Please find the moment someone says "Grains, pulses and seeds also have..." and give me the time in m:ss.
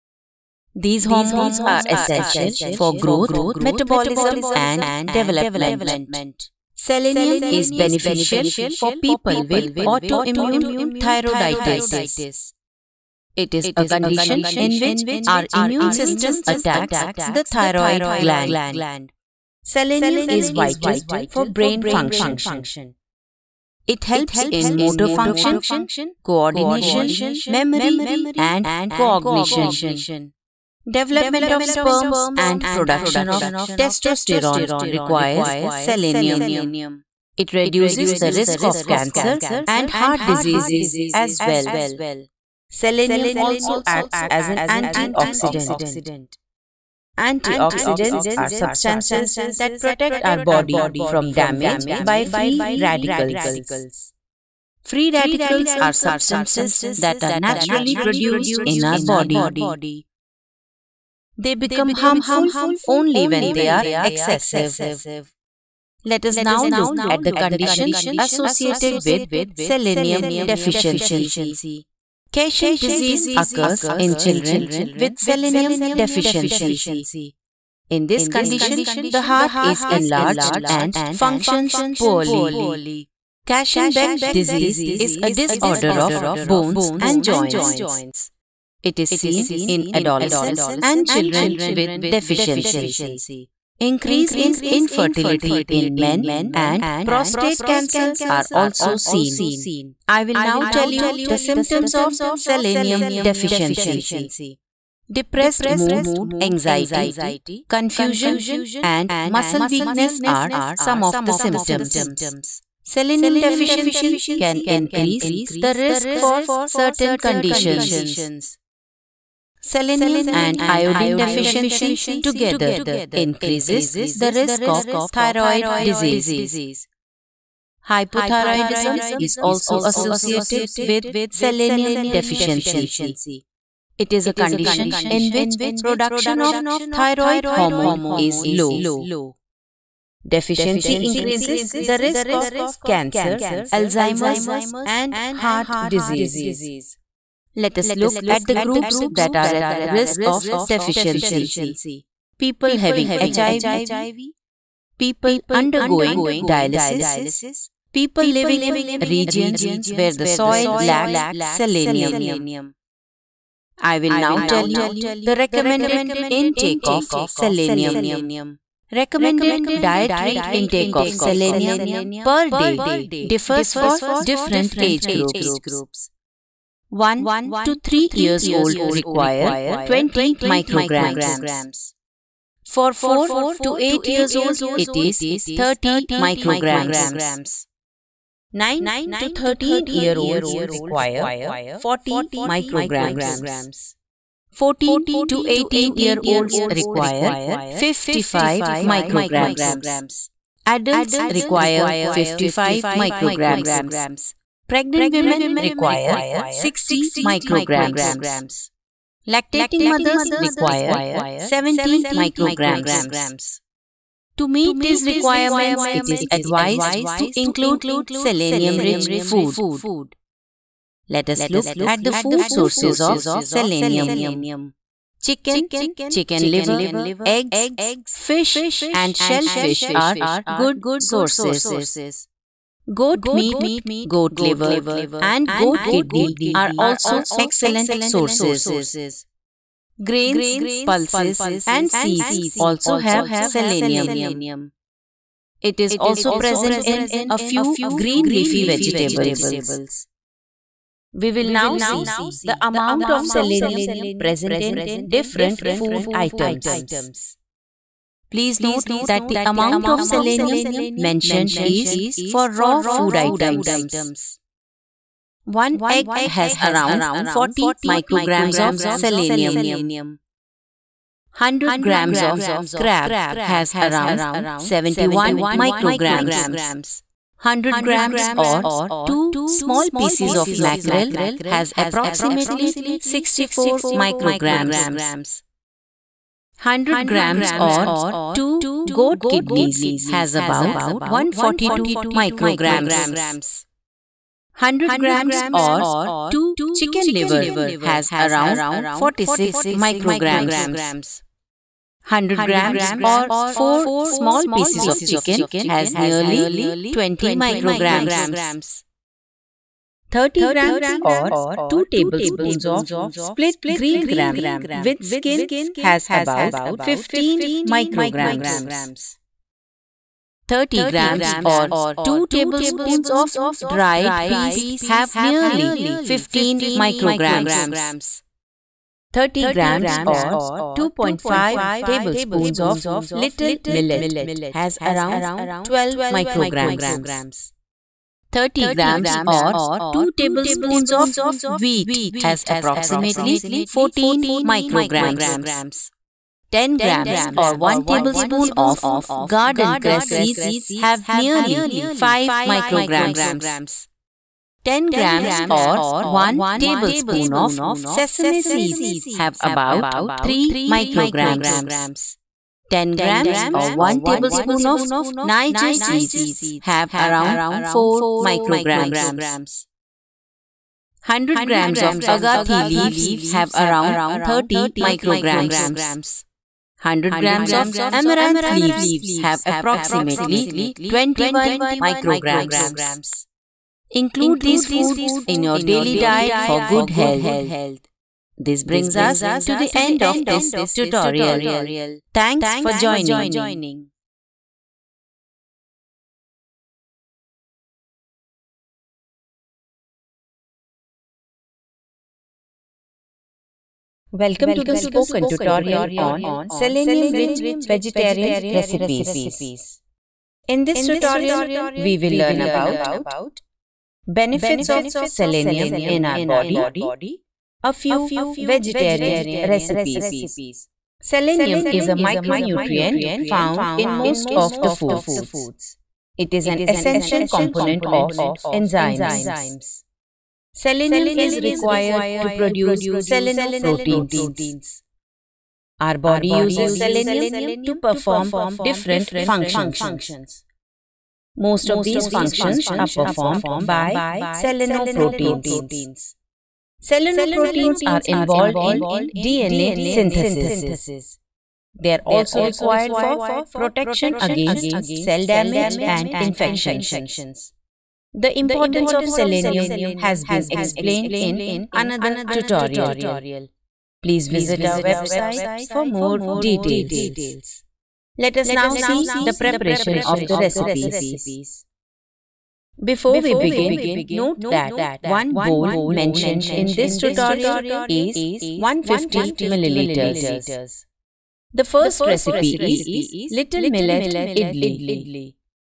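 4:00.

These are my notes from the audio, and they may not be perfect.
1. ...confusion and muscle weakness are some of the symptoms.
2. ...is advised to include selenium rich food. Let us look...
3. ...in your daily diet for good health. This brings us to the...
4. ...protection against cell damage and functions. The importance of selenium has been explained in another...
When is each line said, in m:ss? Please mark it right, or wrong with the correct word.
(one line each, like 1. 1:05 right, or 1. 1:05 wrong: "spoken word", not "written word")
1. 1:47 right
2. 3:36 right
3. 6:25 right
4. 7:33 wrong: "infections", not "functions".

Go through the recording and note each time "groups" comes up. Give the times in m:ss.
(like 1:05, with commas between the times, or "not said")
2:28, 2:55.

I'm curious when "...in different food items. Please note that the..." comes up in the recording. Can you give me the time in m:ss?
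4:14.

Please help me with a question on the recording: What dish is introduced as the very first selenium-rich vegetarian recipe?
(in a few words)
Little Millet Idli.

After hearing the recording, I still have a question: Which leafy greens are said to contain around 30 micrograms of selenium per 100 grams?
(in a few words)
Agathi leaves.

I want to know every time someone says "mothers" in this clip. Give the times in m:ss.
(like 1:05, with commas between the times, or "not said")
3:29.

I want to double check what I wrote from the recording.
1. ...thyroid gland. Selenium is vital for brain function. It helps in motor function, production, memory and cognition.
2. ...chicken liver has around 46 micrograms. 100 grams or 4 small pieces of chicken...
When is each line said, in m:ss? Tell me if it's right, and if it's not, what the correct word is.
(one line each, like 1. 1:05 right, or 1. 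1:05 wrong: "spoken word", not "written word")
1. 0:17 wrong: "coordination", not "production"
2. 4:56 right.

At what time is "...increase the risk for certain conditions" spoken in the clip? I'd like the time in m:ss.
1:54.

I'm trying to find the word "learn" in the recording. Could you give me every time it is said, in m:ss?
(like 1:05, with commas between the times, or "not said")
6:52.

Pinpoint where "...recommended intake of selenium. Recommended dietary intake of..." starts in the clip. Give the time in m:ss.
2:45.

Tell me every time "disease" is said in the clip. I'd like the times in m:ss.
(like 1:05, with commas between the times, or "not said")
0:40, 1:12, 1:24, 2:05, 2:25.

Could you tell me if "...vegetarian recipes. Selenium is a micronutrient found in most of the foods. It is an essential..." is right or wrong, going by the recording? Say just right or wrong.
right.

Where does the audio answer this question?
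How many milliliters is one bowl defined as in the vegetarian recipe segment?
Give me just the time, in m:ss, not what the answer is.
7:58.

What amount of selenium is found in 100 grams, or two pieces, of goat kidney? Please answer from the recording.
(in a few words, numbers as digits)
142 micrograms.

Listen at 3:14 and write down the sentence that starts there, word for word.
14 to 18 year olds require 55 micrograms.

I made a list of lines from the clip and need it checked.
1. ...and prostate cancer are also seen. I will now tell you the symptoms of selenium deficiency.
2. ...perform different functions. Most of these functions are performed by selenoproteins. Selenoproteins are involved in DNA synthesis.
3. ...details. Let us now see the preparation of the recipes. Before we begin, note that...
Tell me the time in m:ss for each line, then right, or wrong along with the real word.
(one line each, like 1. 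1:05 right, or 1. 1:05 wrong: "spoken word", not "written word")
1. 1:36 right
2. 7:17 right
3. 7:46 right.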